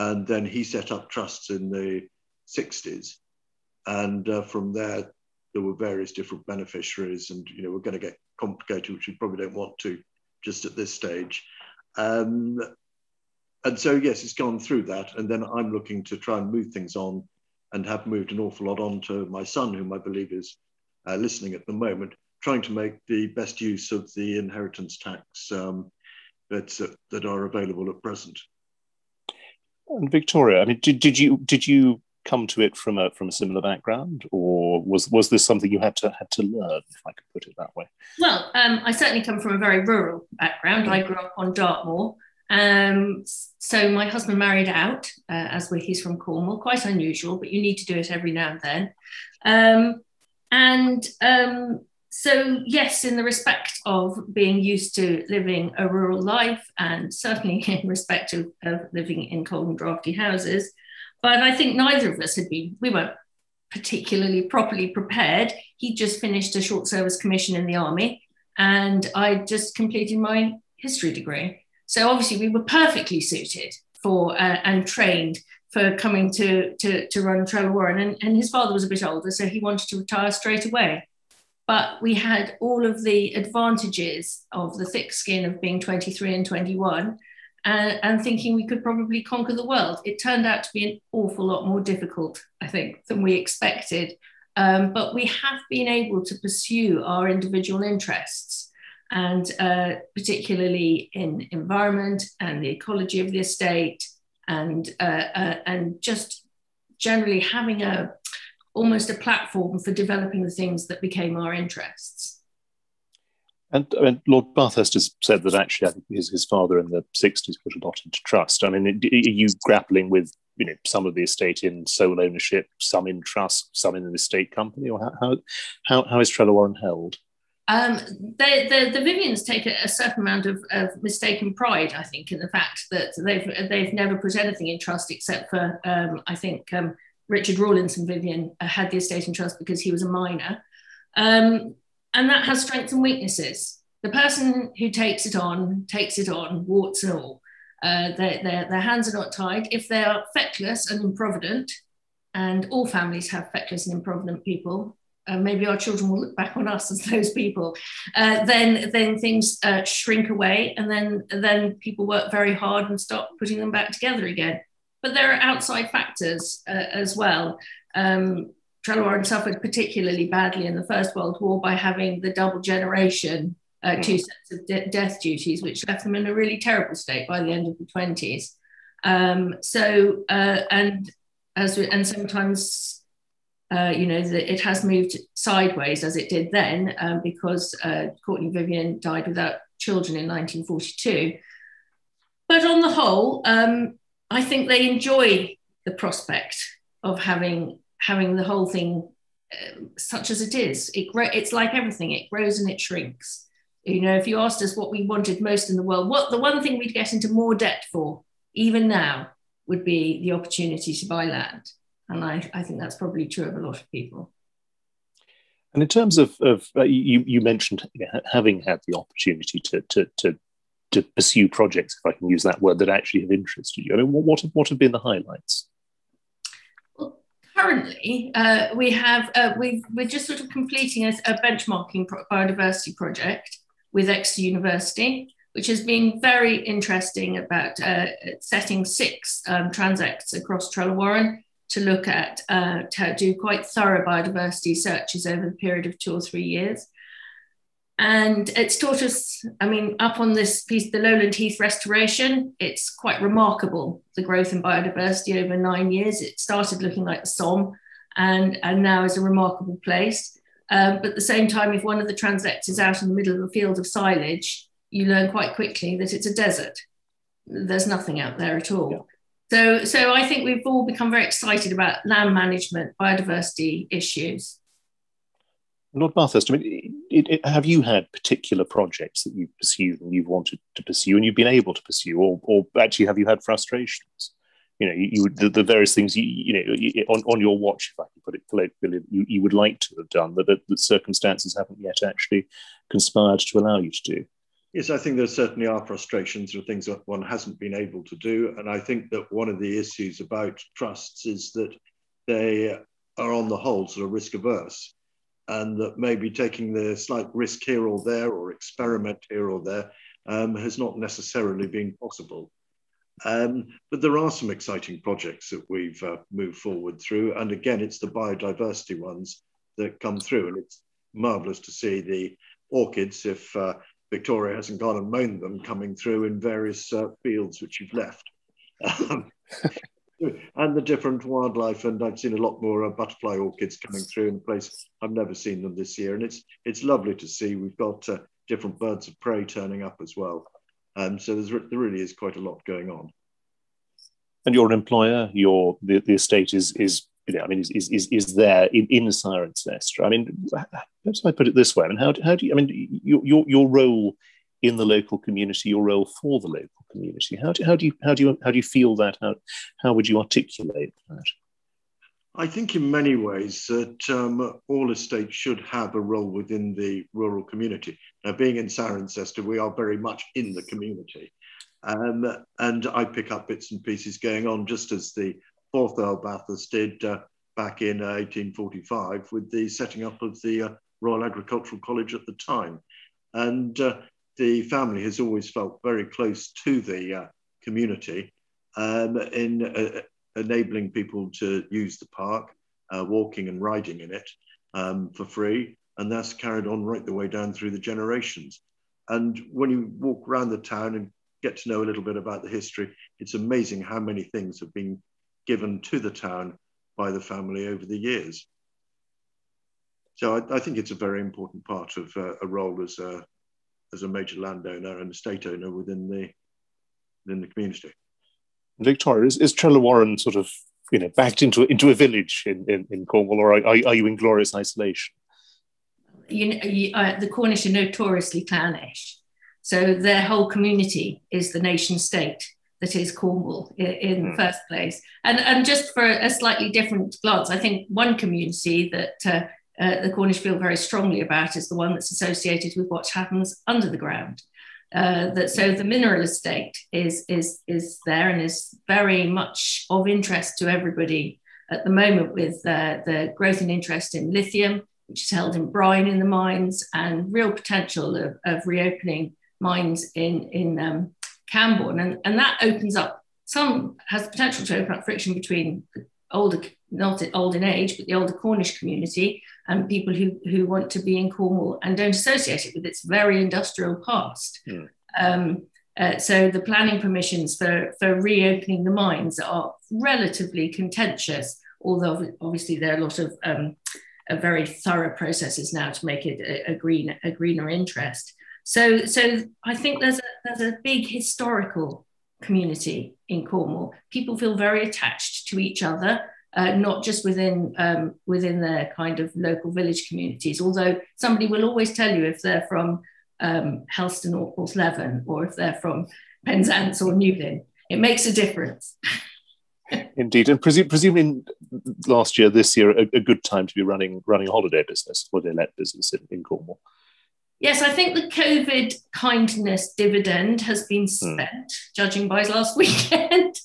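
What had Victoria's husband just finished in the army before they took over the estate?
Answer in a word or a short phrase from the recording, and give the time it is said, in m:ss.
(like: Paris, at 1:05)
Short service commission, at 1:06.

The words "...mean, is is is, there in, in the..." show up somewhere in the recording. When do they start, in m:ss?
5:47.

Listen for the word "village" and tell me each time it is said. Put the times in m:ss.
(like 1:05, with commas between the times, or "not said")
7:01, 8:19.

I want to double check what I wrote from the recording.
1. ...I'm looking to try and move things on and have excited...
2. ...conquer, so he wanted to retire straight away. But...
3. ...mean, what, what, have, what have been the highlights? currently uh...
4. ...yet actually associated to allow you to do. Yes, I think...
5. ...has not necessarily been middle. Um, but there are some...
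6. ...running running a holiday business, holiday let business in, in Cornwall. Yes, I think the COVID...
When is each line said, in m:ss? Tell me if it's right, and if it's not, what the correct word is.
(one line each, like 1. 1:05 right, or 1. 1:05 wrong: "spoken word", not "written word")
1. 0:15 wrong: "moved", not "excited"
2. 1:19 wrong: "older", not "conquer"
3. 3:43 right
4. 4:51 wrong: "conspired", not "associated"
5. 5:10 wrong: "possible", not "middle"
6. 8:33 right.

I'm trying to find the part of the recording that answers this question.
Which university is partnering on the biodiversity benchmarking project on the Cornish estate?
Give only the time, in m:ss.
3:54.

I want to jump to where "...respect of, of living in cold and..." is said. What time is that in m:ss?
0:57.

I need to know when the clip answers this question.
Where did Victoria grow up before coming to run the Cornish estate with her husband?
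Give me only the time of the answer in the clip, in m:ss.
0:41.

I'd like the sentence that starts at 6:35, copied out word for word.
And that's carried on right the way down through the generations.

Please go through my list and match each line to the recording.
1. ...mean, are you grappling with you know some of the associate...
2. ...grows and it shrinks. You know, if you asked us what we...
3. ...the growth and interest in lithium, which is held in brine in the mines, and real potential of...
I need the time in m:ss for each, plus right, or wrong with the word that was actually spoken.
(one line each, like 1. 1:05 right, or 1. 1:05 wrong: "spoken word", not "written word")
1. 1:58 wrong: "estate", not "associate"
2. 3:22 right
3. 7:33 right.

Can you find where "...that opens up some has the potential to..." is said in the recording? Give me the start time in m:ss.
7:42.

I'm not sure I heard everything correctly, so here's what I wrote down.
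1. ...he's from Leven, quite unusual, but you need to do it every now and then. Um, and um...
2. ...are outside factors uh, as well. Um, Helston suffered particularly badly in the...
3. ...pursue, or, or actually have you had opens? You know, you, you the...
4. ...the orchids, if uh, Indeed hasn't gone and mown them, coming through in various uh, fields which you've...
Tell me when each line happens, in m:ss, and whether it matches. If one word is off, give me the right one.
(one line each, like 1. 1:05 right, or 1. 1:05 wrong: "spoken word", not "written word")
1. 0:45 wrong: "Cornwall", not "Leven"
2. 2:45 wrong: "Trelowarren", not "Helston"
3. 4:41 wrong: "frustrations", not "opens"
4. 5:22 wrong: "Victoria", not "Indeed".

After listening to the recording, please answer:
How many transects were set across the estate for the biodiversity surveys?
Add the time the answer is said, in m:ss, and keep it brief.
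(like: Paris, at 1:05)
6, at 3:58.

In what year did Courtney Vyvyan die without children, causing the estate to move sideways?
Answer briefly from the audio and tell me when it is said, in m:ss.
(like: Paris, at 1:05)
1942, at 3:10.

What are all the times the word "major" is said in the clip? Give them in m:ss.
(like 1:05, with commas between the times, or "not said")
6:54.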